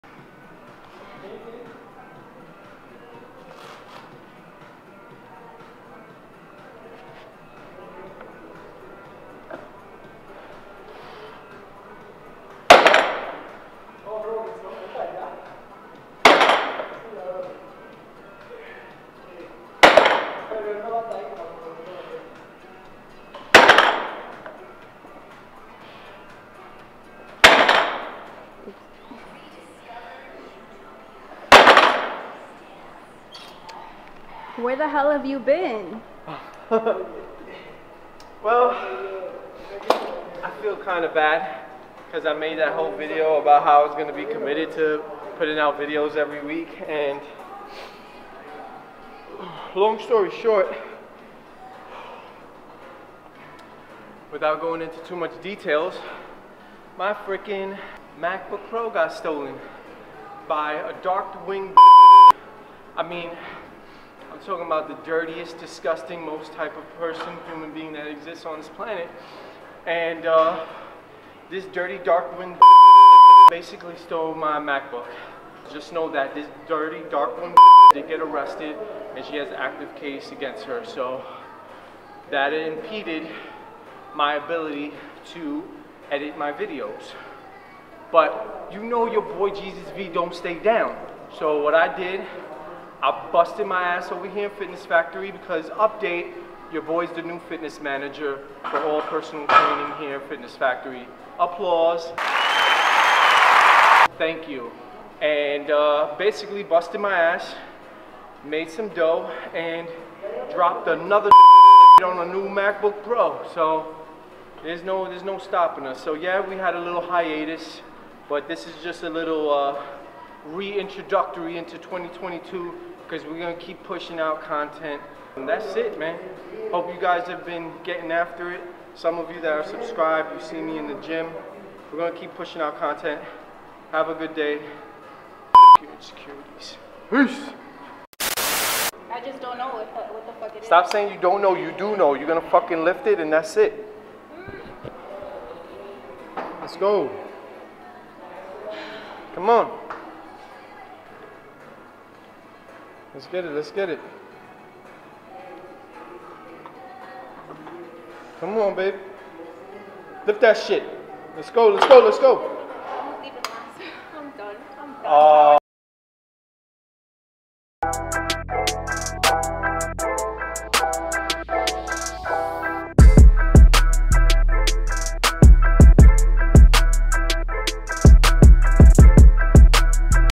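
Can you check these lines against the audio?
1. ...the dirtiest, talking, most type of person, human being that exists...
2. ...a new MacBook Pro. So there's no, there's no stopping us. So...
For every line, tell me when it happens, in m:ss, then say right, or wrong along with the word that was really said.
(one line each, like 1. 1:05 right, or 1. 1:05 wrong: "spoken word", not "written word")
1. 1:04 wrong: "disgusting", not "talking"
2. 1:52 right.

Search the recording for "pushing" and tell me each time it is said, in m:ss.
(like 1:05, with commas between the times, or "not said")
2:03, 2:12.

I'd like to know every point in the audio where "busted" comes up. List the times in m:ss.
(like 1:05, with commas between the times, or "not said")
1:33, 1:46.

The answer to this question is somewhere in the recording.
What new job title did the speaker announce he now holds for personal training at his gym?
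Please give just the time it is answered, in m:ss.
1:37.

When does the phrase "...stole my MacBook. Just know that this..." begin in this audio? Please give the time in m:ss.
1:13.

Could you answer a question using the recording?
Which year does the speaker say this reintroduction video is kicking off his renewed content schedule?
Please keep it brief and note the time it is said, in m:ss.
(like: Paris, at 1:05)
2022, at 2:01.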